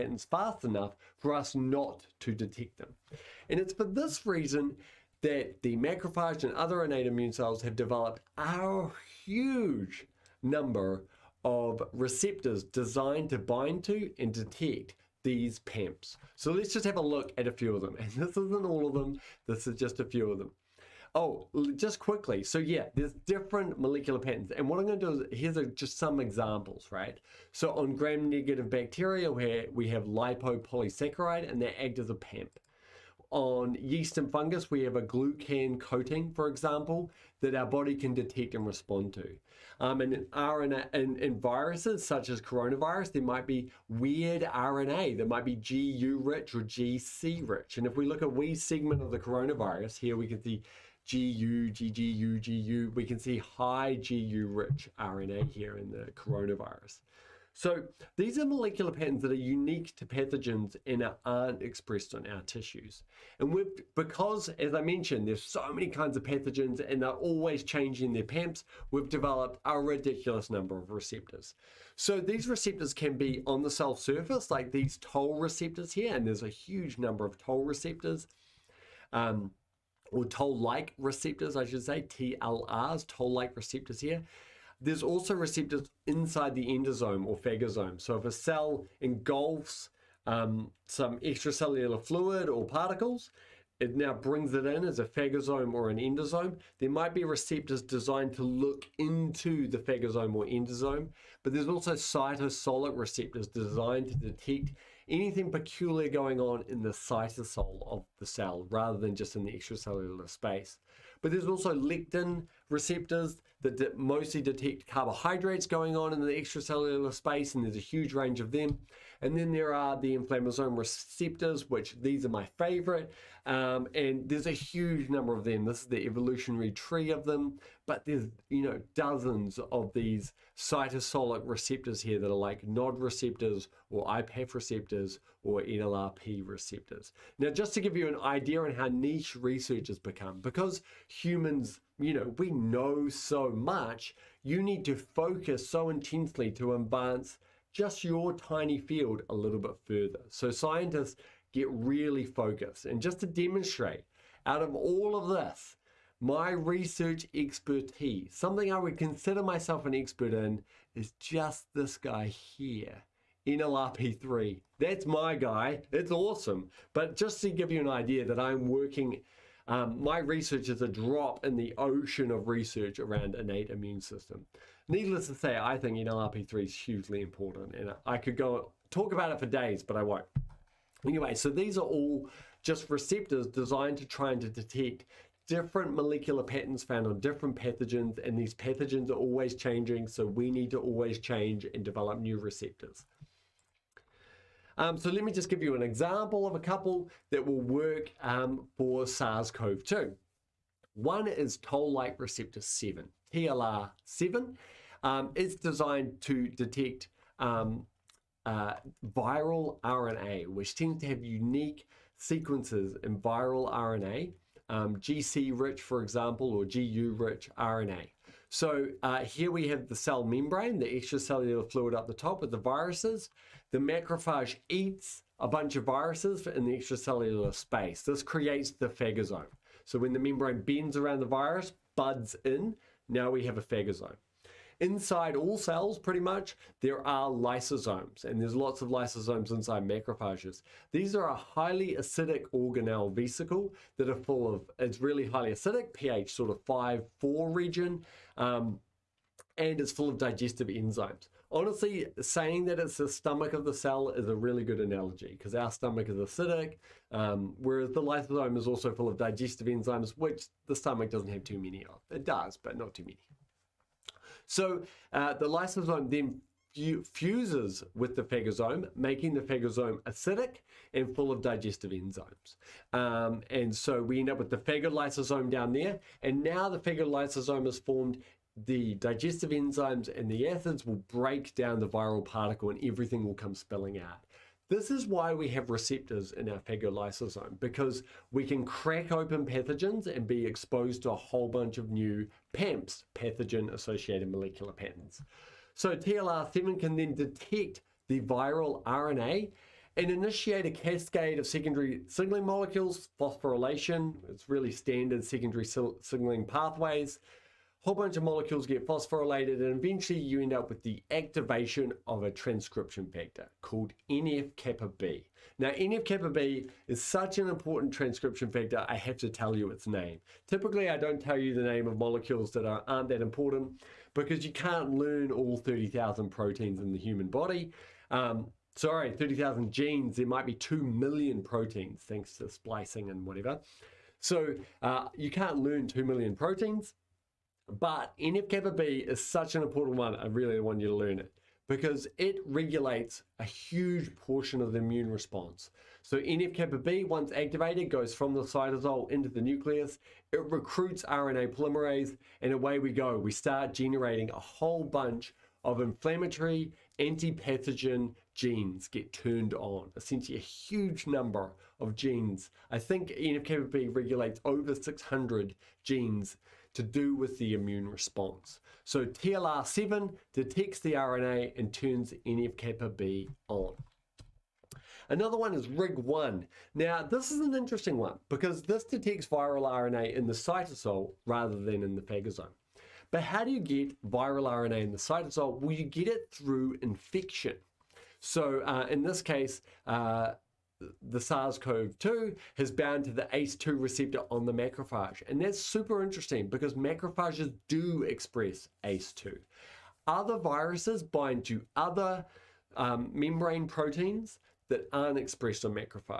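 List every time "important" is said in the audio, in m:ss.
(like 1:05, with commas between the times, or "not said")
2:57, 5:17, 5:23, 5:39.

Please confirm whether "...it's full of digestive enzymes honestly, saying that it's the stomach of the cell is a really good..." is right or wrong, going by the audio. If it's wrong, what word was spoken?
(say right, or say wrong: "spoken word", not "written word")
right.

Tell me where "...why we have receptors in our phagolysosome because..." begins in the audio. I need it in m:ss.
4:45.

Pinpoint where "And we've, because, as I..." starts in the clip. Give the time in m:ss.
1:03.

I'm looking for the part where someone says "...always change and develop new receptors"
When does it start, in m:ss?
3:10.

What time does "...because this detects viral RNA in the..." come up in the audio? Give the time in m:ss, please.
6:18.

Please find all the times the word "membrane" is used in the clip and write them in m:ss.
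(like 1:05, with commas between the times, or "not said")
3:40, 3:50, 6:43.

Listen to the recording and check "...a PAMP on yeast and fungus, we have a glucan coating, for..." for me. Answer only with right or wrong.
right.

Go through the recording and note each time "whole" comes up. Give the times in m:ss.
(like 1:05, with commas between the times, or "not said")
4:51, 5:07, 5:54.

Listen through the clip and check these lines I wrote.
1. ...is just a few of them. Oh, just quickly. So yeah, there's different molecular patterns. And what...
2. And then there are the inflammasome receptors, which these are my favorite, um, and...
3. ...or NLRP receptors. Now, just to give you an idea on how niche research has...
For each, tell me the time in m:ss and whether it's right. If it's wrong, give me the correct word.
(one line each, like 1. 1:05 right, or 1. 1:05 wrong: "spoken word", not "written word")
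1. 0:19 right
2. 1:59 right
3. 2:15 right.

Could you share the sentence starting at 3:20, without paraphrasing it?
One is toll-like receptor 7, TLR7.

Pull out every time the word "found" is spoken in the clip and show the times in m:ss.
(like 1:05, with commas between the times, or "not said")
3:06.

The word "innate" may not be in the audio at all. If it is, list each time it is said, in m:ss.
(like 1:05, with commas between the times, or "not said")
0:06, 2:53.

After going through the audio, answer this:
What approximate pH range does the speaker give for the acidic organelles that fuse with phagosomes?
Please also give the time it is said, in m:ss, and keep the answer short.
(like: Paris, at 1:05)
5 to 4, at 4:05.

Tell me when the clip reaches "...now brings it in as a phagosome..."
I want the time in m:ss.
1:33.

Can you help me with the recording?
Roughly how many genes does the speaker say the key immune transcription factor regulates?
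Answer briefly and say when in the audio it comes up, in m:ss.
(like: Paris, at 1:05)
over 600, at 6:04.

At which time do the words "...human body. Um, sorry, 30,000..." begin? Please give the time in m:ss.
5:26.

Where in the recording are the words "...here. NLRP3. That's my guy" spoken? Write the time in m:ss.
2:42.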